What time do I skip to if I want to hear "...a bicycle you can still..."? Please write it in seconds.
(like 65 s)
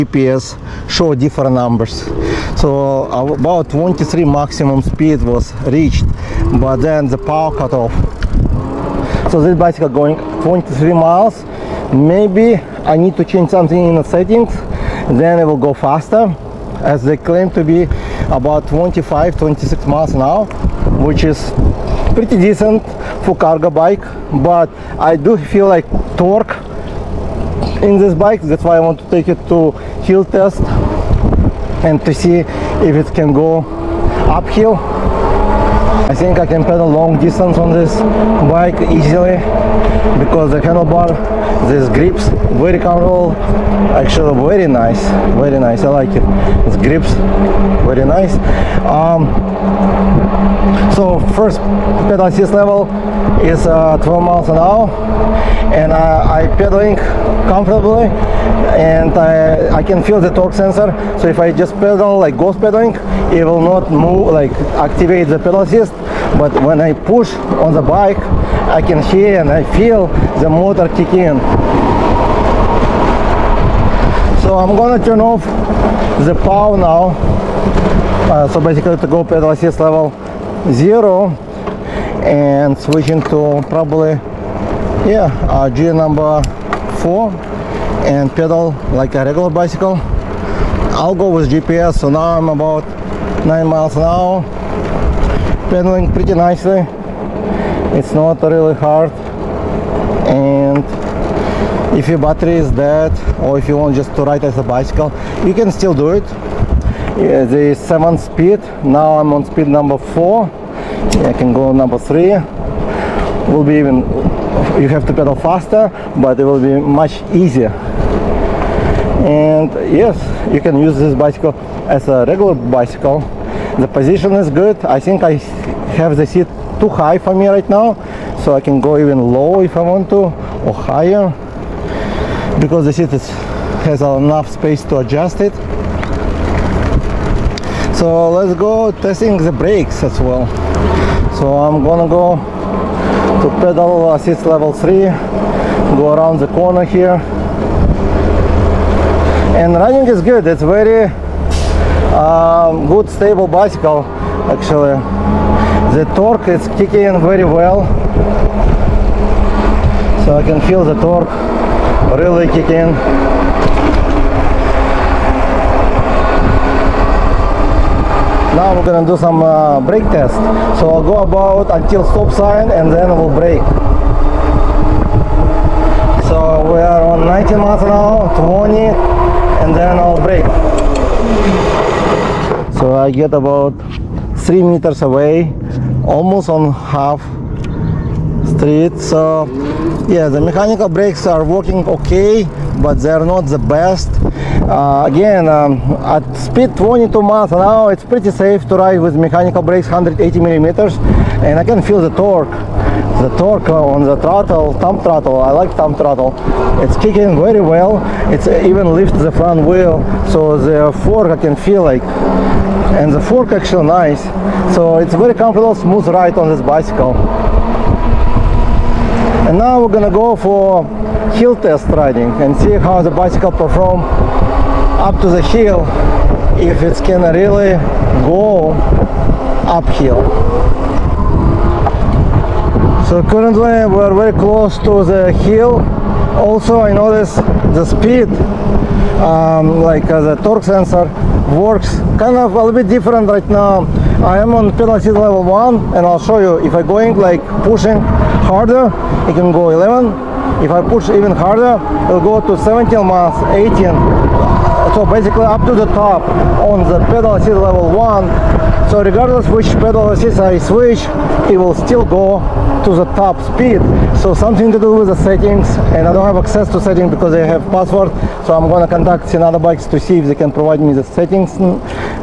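104 s.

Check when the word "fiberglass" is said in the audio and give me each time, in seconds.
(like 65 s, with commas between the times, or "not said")
not said.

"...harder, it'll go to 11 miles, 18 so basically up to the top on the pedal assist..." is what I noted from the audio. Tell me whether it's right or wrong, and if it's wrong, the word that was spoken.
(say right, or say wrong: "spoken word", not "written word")
wrong: "17", not "11".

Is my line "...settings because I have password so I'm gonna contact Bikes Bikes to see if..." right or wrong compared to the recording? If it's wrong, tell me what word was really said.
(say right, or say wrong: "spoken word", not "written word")
wrong: "Senada", not "Bikes".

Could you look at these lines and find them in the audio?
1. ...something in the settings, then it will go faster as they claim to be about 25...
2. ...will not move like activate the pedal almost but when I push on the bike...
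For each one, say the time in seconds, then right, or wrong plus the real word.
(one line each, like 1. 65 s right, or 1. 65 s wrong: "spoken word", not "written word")
1. 13 s right
2. 63 s wrong: "assist", not "almost".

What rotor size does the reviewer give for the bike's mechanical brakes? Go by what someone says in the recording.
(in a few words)
180 millimeters.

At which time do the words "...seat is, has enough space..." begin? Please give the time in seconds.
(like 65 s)
132 s.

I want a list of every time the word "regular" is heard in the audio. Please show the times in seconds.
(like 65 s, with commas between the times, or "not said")
89 s, 122 s.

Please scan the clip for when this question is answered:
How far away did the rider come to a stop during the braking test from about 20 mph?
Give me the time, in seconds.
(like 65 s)
184 s.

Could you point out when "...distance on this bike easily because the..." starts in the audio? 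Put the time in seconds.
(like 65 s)
37 s.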